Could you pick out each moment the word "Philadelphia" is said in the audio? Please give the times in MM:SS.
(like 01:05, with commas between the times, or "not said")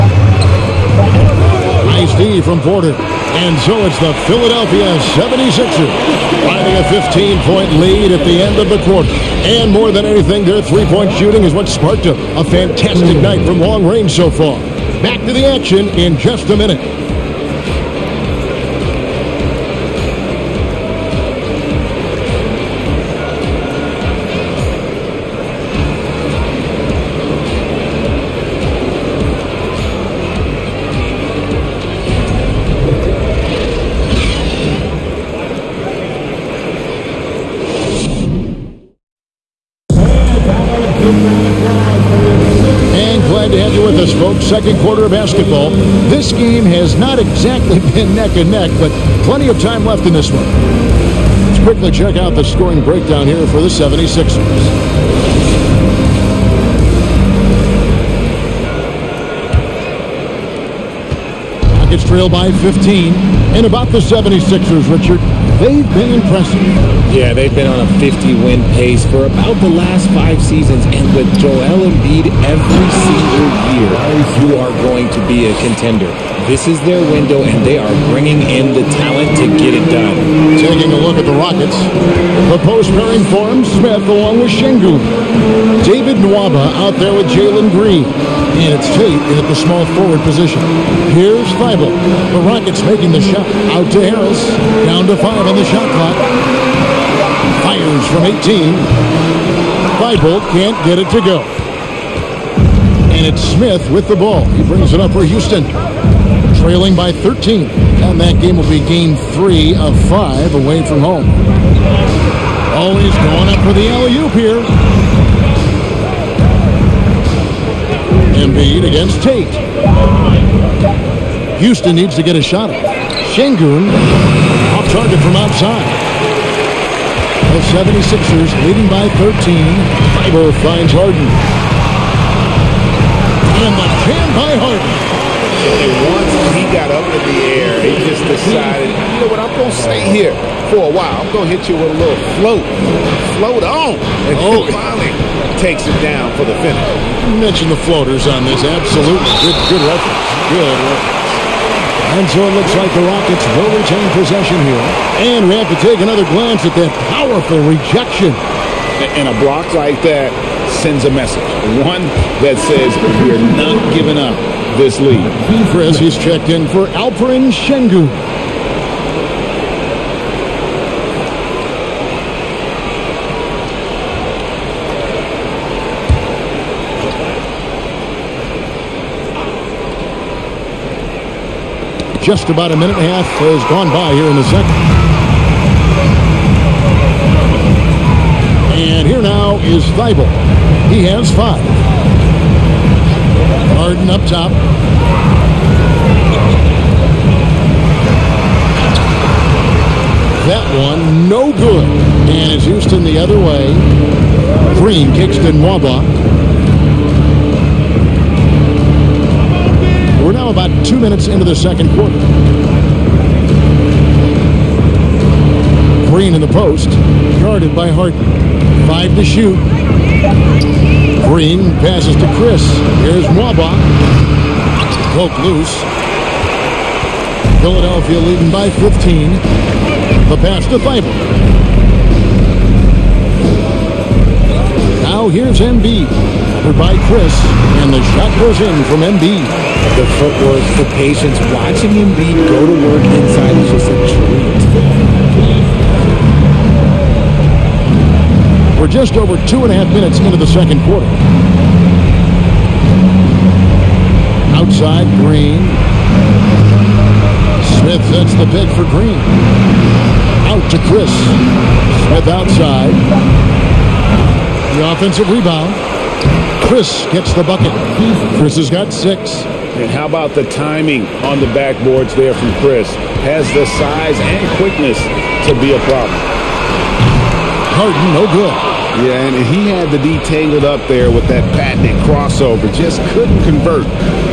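00:04, 03:47.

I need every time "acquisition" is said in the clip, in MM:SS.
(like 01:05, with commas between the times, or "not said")
not said.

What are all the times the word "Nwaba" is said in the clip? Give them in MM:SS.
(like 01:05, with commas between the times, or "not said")
01:26, 03:25, 03:43.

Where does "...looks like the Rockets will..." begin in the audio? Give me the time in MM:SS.
02:32.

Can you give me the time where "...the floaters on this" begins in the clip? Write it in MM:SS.
02:27.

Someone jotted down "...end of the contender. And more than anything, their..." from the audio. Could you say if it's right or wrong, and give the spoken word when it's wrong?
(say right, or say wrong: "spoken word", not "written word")
wrong: "quarter", not "contender".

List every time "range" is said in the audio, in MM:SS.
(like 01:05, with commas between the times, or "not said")
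00:13.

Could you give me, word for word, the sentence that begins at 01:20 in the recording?
Taking a look at the Rockets, the post pairing for him, Smith along with Sengun.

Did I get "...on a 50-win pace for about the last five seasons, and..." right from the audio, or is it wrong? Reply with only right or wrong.
right.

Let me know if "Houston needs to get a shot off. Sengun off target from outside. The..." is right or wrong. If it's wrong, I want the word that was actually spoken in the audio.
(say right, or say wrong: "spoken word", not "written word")
right.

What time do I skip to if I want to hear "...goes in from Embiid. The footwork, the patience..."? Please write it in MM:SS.
03:58.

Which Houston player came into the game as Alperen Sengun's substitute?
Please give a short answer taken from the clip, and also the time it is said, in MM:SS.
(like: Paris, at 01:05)
Fres, at 02:45.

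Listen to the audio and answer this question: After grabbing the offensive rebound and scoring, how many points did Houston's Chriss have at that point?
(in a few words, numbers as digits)
6.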